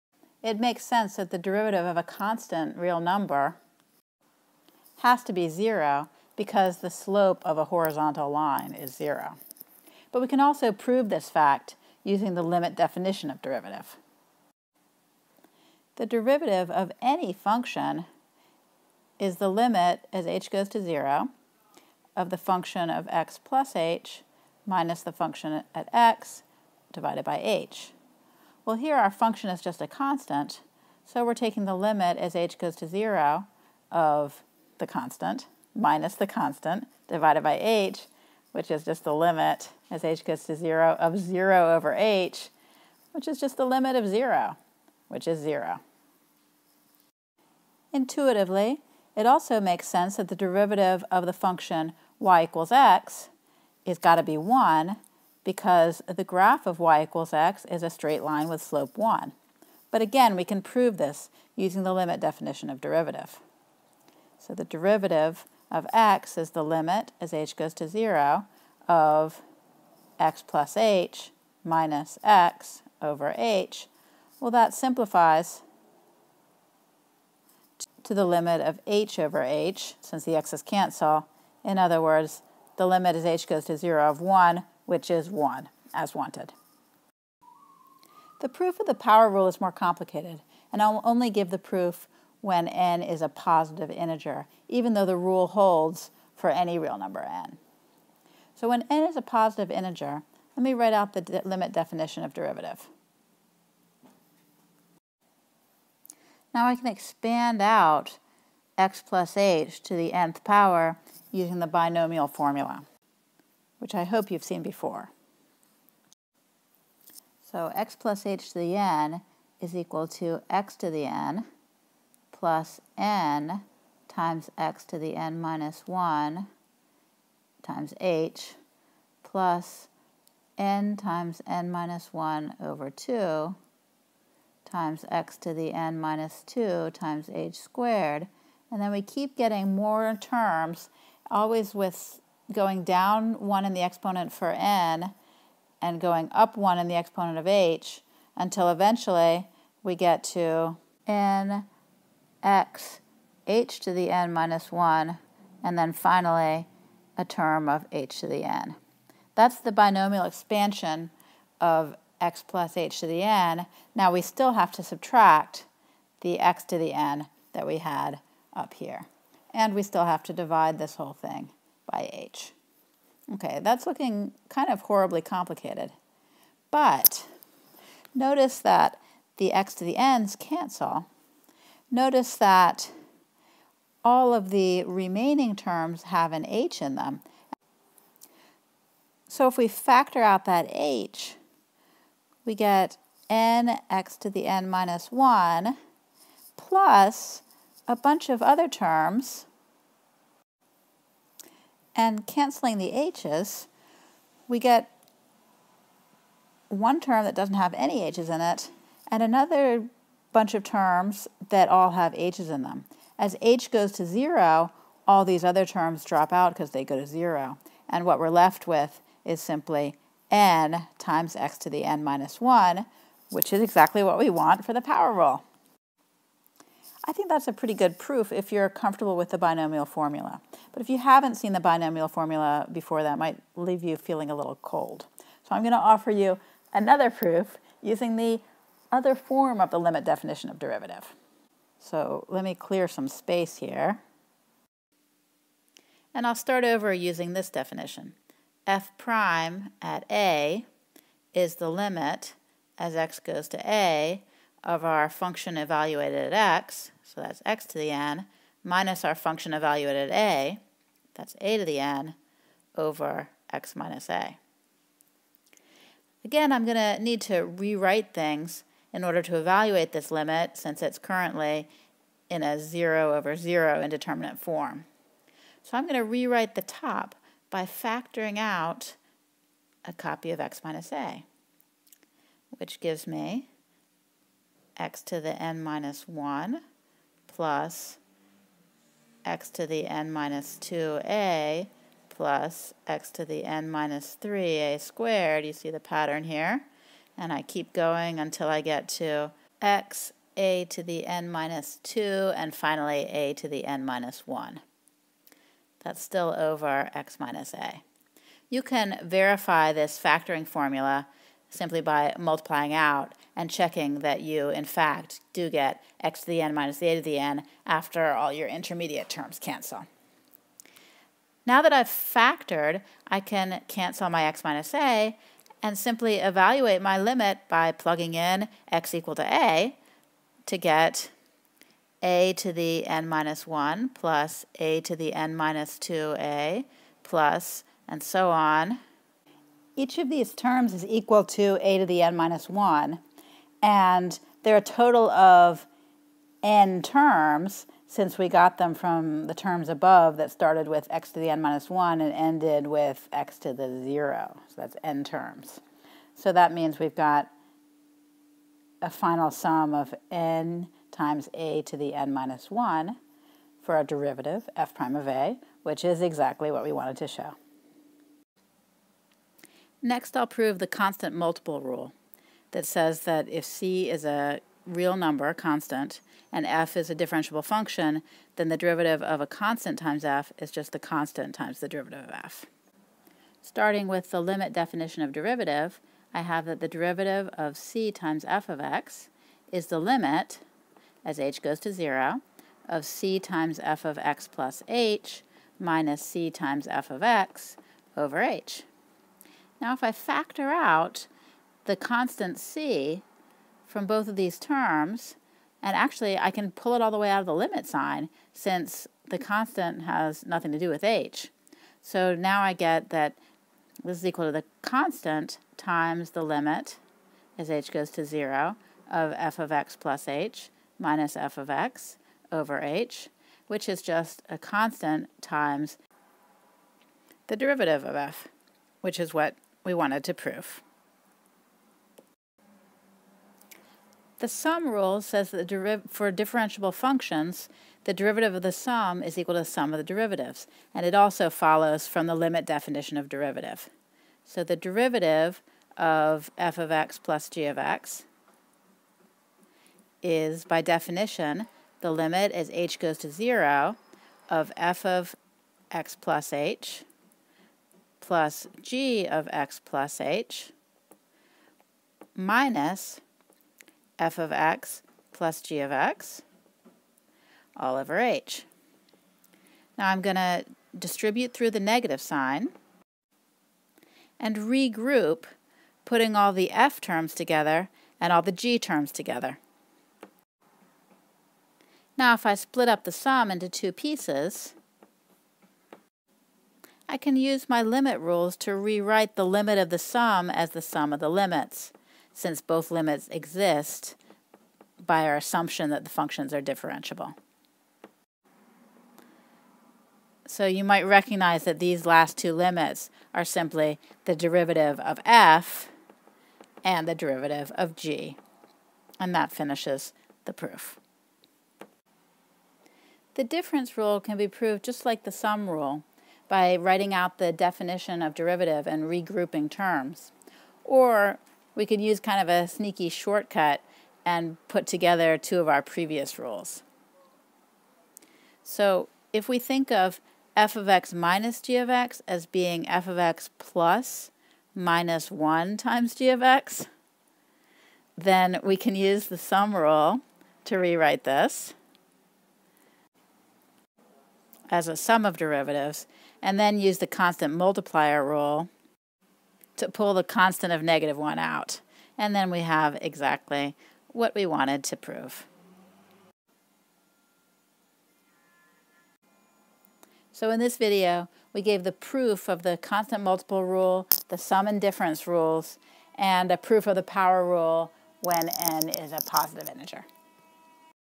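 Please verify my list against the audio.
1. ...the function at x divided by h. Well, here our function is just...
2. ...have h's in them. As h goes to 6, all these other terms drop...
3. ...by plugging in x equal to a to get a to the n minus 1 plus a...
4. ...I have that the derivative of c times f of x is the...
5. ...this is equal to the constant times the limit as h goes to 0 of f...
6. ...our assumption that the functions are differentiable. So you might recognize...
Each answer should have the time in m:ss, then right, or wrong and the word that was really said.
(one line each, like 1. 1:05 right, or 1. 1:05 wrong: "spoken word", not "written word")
1. 0:25 right
2. 3:31 wrong: "0", not "6"
3. 5:27 right
4. 6:26 right
5. 6:53 right
6. 8:15 right.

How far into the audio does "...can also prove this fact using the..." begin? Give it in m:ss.
0:10.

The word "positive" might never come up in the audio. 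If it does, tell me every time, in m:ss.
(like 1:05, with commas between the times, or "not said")
1:33, 1:39, 9:29.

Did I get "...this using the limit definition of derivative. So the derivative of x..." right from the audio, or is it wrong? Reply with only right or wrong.
right.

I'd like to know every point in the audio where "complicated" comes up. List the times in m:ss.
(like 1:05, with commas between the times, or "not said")
1:29, 2:55.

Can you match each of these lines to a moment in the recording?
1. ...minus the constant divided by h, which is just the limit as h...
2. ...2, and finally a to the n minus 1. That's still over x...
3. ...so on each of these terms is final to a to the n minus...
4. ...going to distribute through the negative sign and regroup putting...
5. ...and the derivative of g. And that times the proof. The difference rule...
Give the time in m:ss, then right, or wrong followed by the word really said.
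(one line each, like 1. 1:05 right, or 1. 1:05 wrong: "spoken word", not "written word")
1. 0:35 right
2. 5:01 right
3. 5:38 wrong: "equal", not "final"
4. 7:50 right
5. 8:26 wrong: "finishes", not "times".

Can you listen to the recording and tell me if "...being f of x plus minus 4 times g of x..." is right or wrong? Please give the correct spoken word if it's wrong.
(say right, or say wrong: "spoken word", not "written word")
wrong: "1", not "4".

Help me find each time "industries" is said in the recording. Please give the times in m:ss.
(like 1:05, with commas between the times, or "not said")
not said.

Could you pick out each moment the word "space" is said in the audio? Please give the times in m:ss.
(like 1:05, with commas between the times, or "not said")
4:03.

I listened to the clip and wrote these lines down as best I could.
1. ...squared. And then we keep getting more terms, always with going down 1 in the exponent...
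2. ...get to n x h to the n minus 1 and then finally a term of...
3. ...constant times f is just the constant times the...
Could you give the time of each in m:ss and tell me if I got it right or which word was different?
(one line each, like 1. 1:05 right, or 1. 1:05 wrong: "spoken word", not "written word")
1. 2:17 right
2. 2:29 right
3. 6:19 right.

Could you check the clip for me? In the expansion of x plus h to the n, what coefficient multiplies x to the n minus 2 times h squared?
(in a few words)
n times n minus 1 over 2.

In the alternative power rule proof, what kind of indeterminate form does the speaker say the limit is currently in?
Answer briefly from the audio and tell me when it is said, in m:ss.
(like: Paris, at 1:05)
0 over 0, at 4:32.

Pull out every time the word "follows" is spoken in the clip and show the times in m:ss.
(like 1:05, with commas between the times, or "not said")
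7:21.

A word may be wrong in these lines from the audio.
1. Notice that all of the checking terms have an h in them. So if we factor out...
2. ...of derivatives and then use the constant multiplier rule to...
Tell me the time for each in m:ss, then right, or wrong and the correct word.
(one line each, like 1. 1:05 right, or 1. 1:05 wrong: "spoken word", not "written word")
1. 3:01 wrong: "remaining", not "checking"
2. 9:05 right.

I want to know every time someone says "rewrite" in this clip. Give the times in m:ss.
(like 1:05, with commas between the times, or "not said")
4:27, 4:36, 8:08, 9:00.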